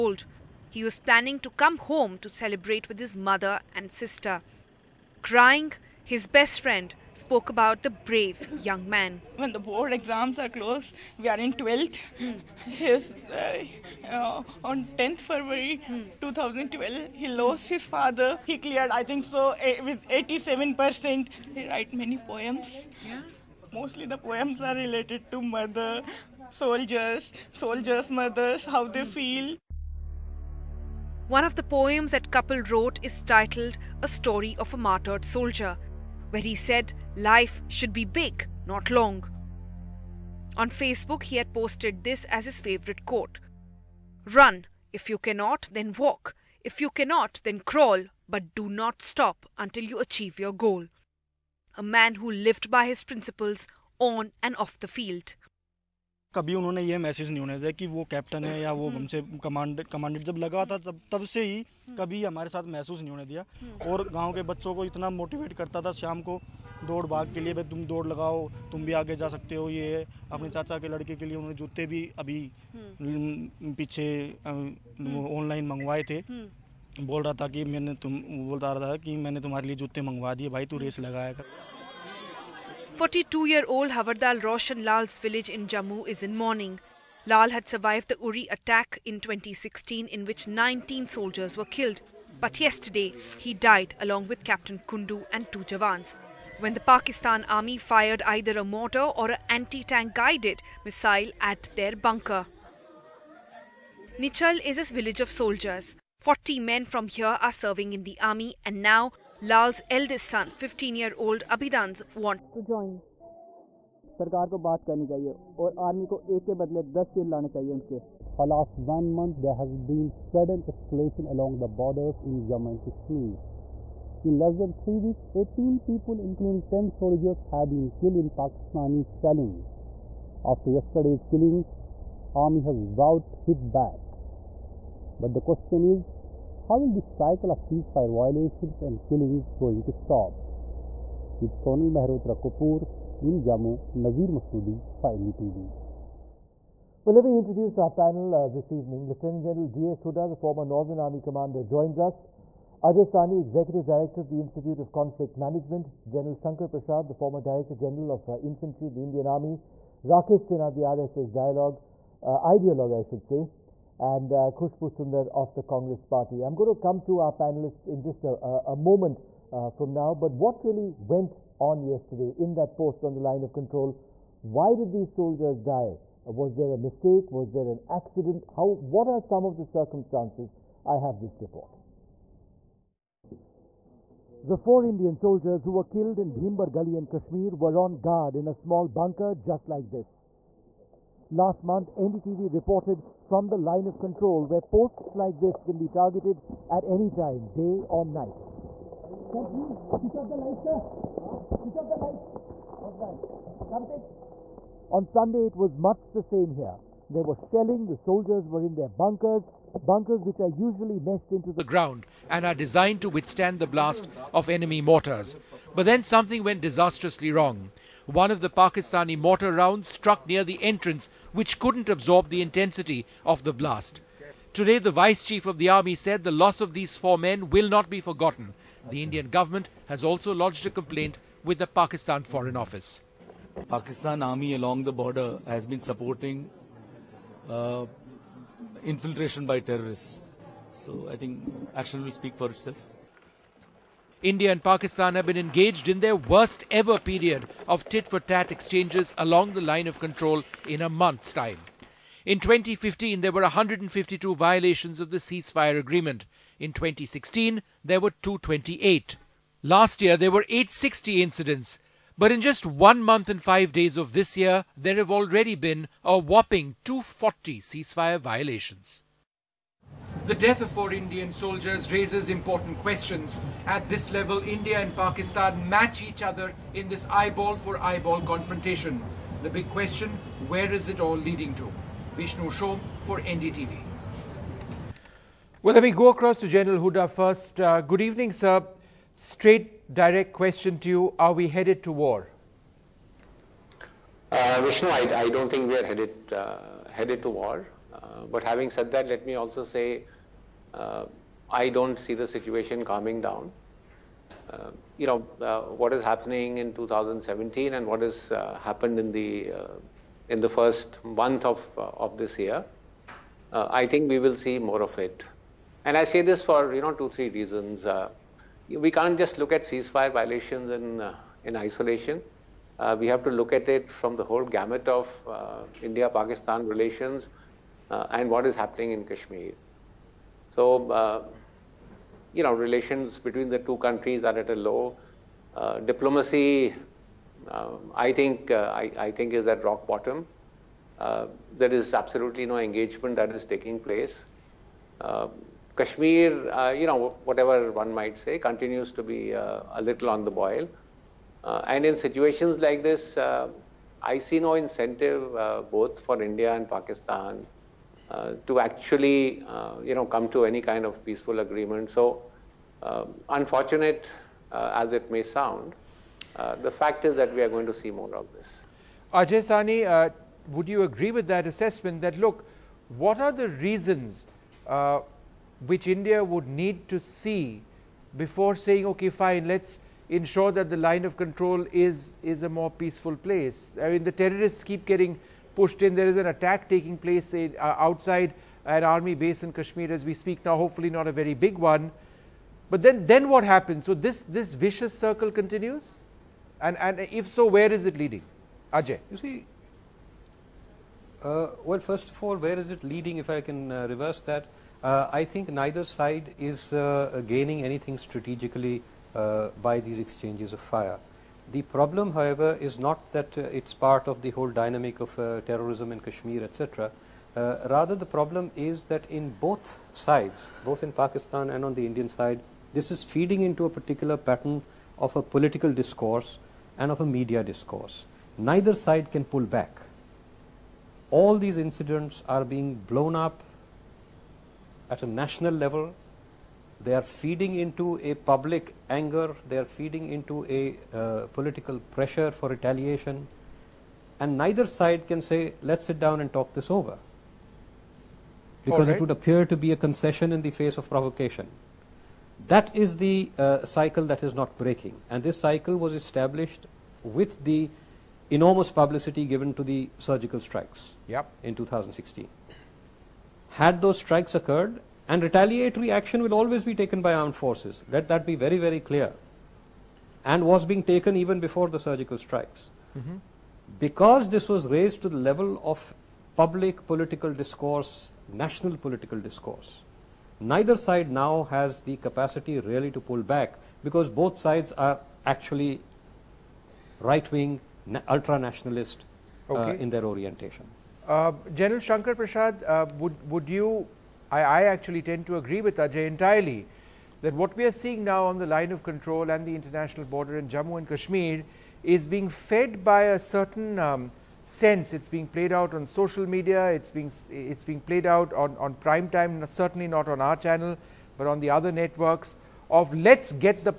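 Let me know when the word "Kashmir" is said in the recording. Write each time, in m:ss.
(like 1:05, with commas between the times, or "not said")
2:02, 3:07, 5:29, 5:45, 6:29, 6:55, 8:20.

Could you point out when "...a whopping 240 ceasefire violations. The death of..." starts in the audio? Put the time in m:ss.
4:26.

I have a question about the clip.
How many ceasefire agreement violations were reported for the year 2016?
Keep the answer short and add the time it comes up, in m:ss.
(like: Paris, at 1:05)
228, at 4:18.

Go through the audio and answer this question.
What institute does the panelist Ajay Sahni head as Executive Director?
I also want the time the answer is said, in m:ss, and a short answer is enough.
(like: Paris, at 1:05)
Institute of Conflict Management, at 2:34.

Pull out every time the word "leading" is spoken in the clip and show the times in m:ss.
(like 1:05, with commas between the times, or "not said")
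4:41, 6:38, 6:42.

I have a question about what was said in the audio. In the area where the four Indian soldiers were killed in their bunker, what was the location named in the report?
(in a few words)
Bhimber Gali.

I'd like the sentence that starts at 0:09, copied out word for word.
When the board exams are closed, we are in 12th.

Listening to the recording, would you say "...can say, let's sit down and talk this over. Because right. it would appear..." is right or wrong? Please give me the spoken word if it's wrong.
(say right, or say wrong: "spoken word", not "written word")
right.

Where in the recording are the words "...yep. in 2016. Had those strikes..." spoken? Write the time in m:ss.
7:41.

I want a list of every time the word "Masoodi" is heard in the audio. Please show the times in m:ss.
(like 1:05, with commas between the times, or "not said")
2:24.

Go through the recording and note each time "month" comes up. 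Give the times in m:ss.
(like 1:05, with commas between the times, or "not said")
1:59, 3:11, 4:10, 4:23, 5:11.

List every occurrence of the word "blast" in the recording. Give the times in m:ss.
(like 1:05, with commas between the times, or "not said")
3:33, 3:43.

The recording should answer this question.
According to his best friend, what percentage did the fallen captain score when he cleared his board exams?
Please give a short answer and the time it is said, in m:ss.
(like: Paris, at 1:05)
87%, at 0:20.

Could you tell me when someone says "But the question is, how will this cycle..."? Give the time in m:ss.
2:15.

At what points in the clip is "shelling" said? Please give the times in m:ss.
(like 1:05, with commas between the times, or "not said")
2:09, 3:27.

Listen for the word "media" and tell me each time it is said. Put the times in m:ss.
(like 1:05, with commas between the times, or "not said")
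7:07, 8:26.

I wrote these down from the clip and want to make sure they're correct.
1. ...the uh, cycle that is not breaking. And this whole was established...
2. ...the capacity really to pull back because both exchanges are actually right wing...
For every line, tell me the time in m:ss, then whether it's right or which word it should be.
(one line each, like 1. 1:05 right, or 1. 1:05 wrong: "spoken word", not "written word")
1. 7:32 wrong: "cycle", not "whole"
2. 8:01 wrong: "sides", not "exchanges".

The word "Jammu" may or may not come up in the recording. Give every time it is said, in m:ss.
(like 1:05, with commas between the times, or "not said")
1:25, 2:02, 2:23, 8:20.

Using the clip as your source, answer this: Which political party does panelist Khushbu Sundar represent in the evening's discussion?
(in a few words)
Congress Party.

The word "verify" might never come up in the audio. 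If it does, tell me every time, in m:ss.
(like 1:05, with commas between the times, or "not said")
not said.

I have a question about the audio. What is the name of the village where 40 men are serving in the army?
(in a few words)
Nichal.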